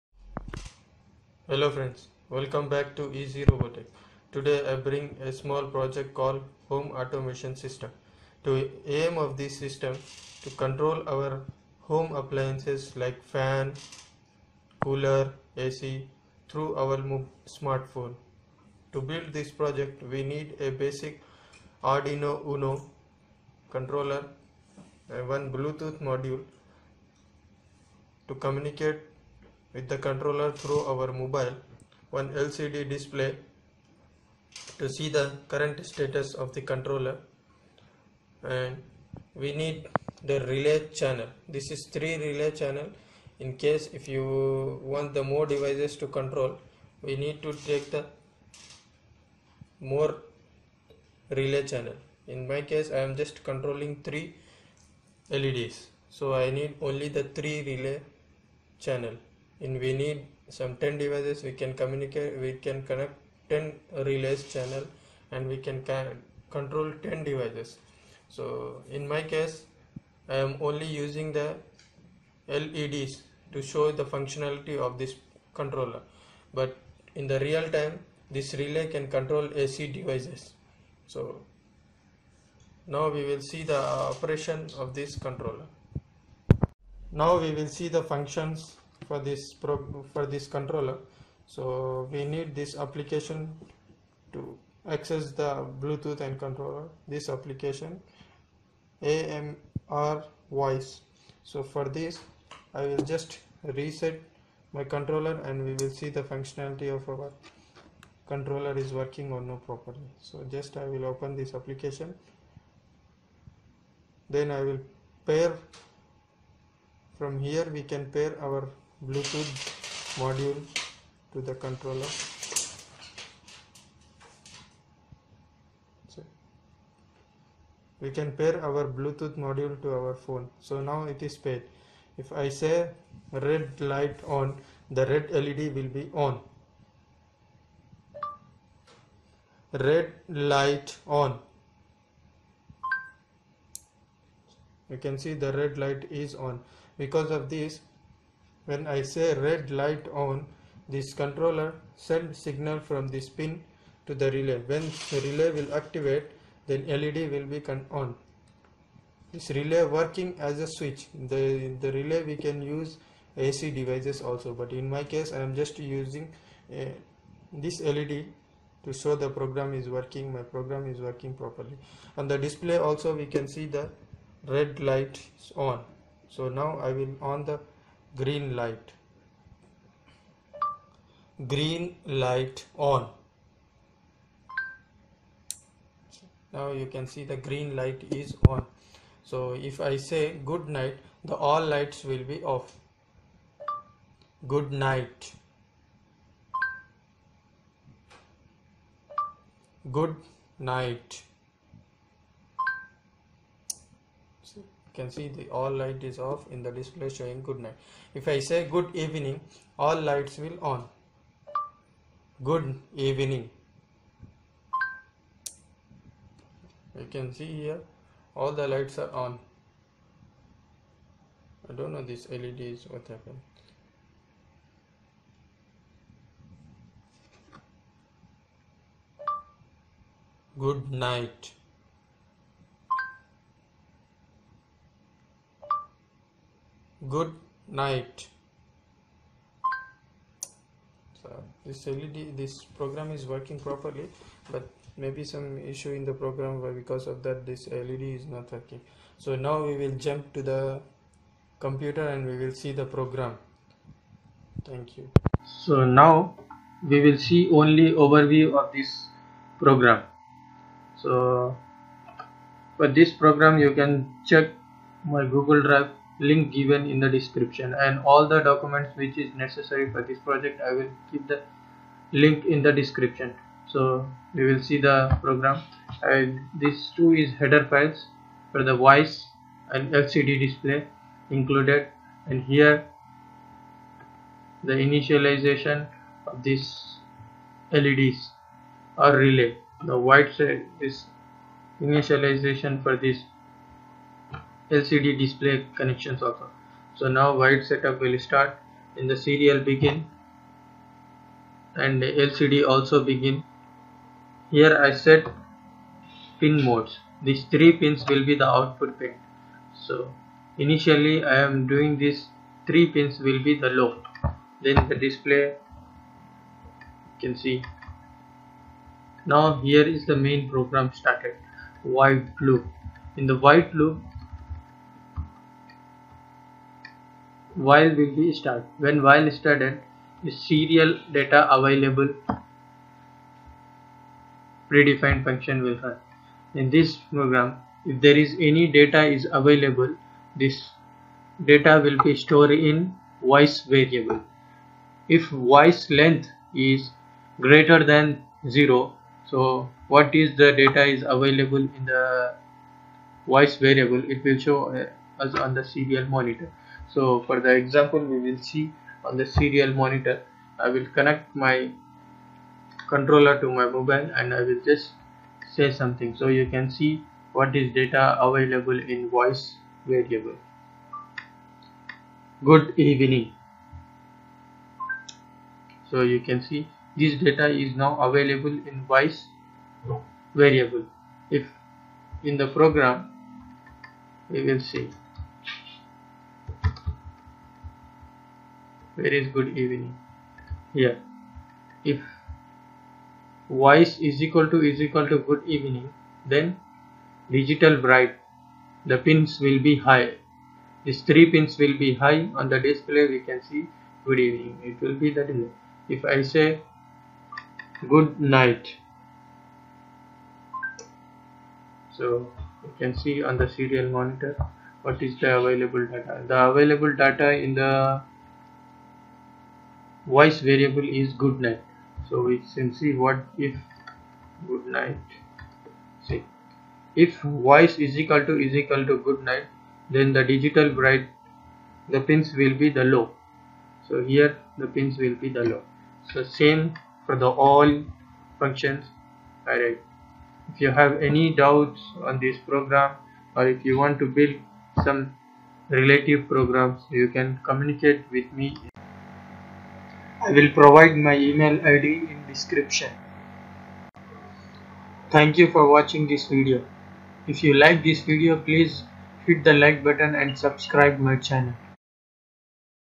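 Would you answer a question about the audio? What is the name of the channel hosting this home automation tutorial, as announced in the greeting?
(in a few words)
EasyRoboTech.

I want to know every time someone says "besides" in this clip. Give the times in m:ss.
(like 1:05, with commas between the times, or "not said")
not said.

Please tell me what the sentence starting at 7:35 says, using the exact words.
Thank you for watching this video.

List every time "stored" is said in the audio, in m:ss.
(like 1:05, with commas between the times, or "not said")
5:42.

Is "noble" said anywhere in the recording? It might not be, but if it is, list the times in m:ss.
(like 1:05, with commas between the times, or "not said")
not said.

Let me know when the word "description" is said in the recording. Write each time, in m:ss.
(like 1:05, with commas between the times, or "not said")
4:27, 4:32, 7:32.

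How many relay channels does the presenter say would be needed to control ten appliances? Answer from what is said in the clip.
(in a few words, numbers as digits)
10.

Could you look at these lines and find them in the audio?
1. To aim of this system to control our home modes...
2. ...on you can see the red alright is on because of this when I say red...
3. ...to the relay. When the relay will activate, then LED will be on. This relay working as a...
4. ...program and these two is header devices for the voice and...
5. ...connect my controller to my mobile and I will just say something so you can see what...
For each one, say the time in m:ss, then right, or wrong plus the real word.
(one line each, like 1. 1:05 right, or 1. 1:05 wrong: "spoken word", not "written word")
1. 0:08 wrong: "appliances", not "modes"
2. 2:21 wrong: "light", not "alright"
3. 2:34 right
4. 4:35 wrong: "files", not "devices"
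5. 6:00 right.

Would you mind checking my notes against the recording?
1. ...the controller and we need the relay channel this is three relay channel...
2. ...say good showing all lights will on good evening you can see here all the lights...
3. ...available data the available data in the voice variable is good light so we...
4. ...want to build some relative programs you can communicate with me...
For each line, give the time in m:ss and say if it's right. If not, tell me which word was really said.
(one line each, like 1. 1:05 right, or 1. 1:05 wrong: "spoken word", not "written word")
1. 0:36 right
2. 3:28 wrong: "evening", not "showing"
3. 6:55 wrong: "night", not "light"
4. 7:23 right.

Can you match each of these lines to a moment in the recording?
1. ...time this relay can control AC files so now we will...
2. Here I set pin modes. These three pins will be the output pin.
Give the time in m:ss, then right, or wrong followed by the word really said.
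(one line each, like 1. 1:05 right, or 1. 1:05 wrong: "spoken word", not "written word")
1. 1:17 wrong: "devices", not "files"
2. 5:04 right.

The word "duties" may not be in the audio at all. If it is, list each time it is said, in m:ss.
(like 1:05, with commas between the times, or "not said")
not said.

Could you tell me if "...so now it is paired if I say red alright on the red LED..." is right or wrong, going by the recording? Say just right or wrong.
wrong.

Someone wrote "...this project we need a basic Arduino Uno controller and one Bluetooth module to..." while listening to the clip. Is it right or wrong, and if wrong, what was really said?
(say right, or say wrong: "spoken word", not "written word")
right.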